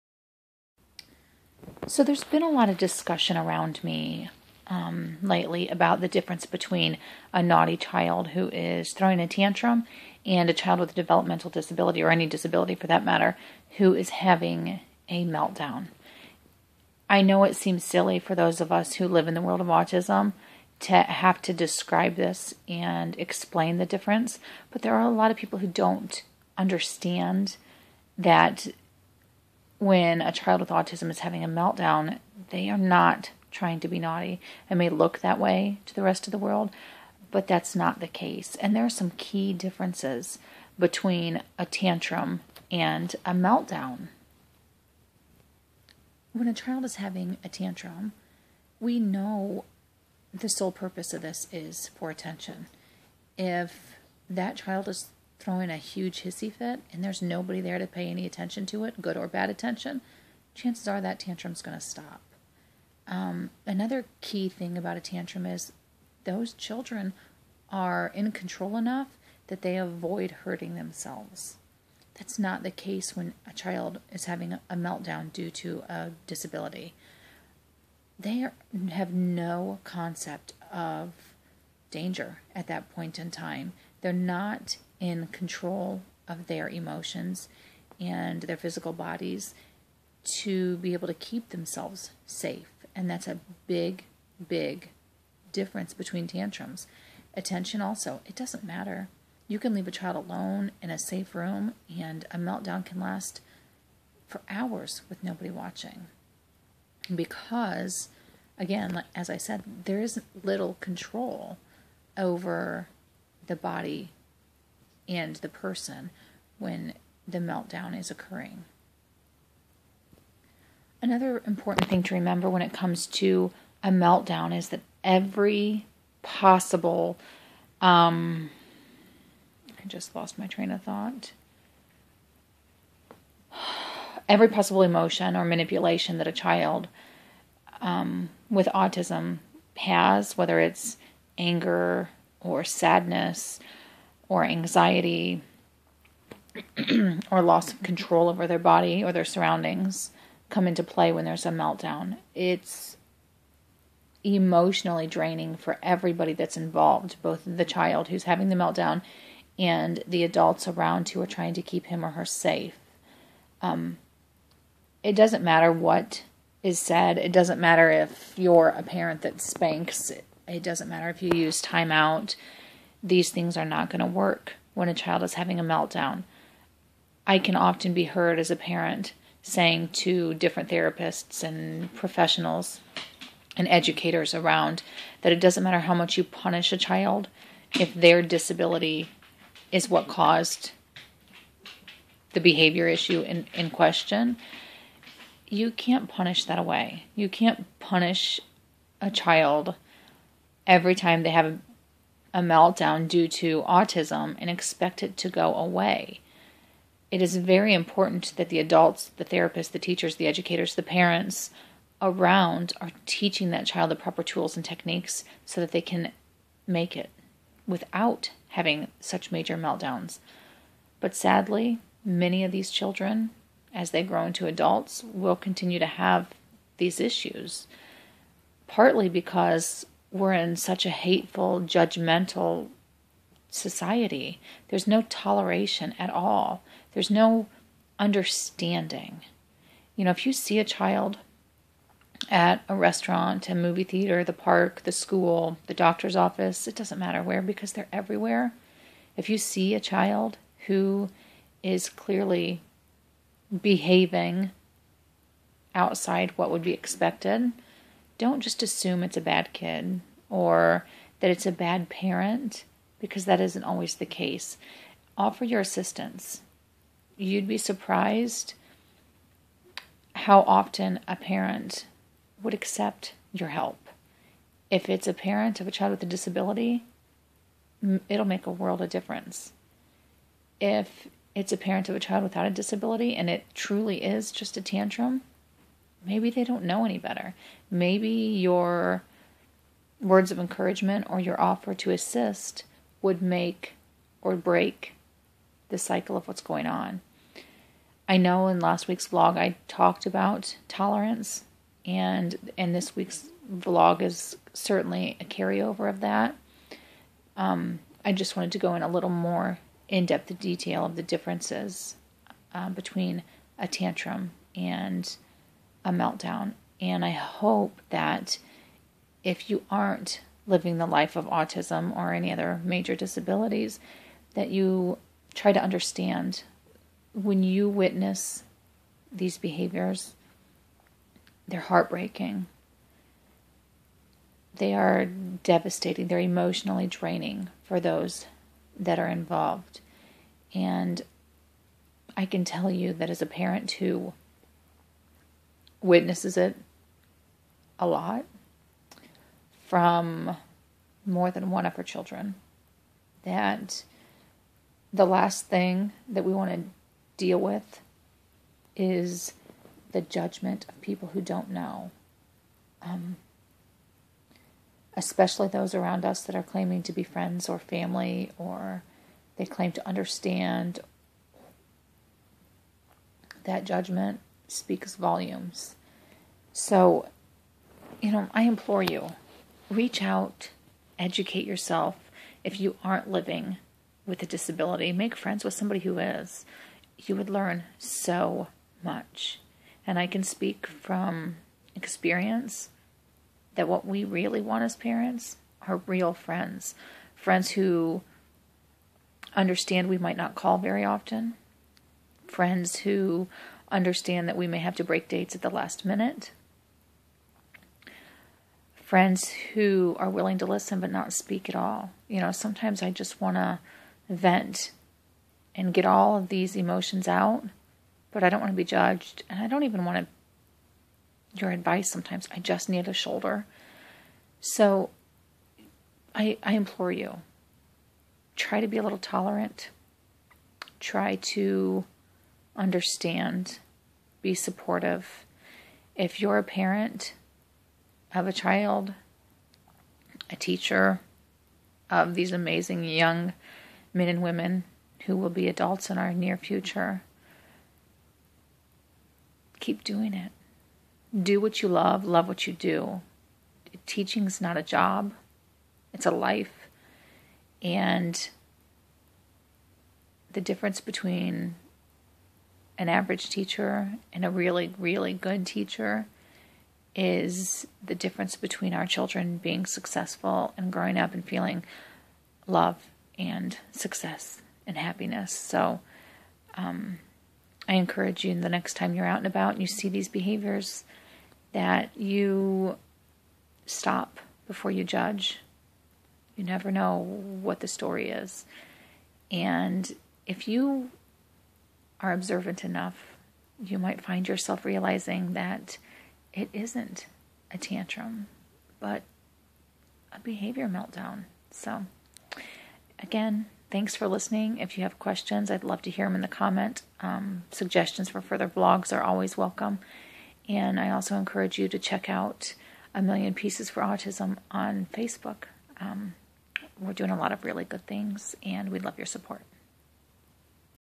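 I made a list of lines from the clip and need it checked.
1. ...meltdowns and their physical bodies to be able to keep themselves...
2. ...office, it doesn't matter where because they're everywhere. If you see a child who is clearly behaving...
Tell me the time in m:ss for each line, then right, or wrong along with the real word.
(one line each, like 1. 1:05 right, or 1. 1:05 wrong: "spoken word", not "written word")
1. 1:26 wrong: "emotions", not "meltdowns"
2. 4:06 right.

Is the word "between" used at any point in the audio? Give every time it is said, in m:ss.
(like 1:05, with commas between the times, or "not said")
0:06, 0:40, 1:35, 5:12, 7:40, 7:48.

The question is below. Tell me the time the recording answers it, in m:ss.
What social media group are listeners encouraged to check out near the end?
8:32.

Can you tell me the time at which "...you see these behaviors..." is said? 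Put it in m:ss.
7:59.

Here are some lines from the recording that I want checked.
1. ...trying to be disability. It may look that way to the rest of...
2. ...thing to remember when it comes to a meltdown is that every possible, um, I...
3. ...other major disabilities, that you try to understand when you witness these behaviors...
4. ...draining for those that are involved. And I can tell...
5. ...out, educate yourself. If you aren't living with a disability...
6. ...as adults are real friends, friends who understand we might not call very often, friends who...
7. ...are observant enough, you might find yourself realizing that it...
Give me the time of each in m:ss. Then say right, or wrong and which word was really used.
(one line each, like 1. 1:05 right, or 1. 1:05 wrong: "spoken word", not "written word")
1. 0:33 wrong: "naughty", not "disability"
2. 2:01 right
3. 5:22 right
4. 5:36 right
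5. 6:20 right
6. 6:34 wrong: "parents", not "adults"
7. 8:12 right.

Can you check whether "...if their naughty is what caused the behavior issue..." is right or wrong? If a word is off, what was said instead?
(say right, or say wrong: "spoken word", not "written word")
wrong: "disability", not "naughty".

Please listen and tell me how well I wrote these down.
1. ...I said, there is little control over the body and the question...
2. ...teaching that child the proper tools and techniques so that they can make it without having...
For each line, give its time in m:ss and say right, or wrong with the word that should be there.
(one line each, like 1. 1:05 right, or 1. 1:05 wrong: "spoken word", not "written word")
1. 1:49 wrong: "person", not "question"
2. 3:33 right.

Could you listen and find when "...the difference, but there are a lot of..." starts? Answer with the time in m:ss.
0:23.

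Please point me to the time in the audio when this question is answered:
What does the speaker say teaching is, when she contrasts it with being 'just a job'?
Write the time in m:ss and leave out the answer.
7:36.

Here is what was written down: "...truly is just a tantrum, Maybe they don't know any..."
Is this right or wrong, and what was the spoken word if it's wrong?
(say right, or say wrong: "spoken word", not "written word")
right.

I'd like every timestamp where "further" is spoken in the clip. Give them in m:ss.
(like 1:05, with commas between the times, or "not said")
8:28.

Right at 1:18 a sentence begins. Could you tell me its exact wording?
They are, have no concept of danger at that point in time.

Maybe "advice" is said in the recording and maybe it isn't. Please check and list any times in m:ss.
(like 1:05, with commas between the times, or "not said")
7:01.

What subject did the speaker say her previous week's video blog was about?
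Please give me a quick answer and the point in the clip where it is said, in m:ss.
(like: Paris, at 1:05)
Tolerance, at 5:00.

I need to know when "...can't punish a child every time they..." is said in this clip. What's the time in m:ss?
3:17.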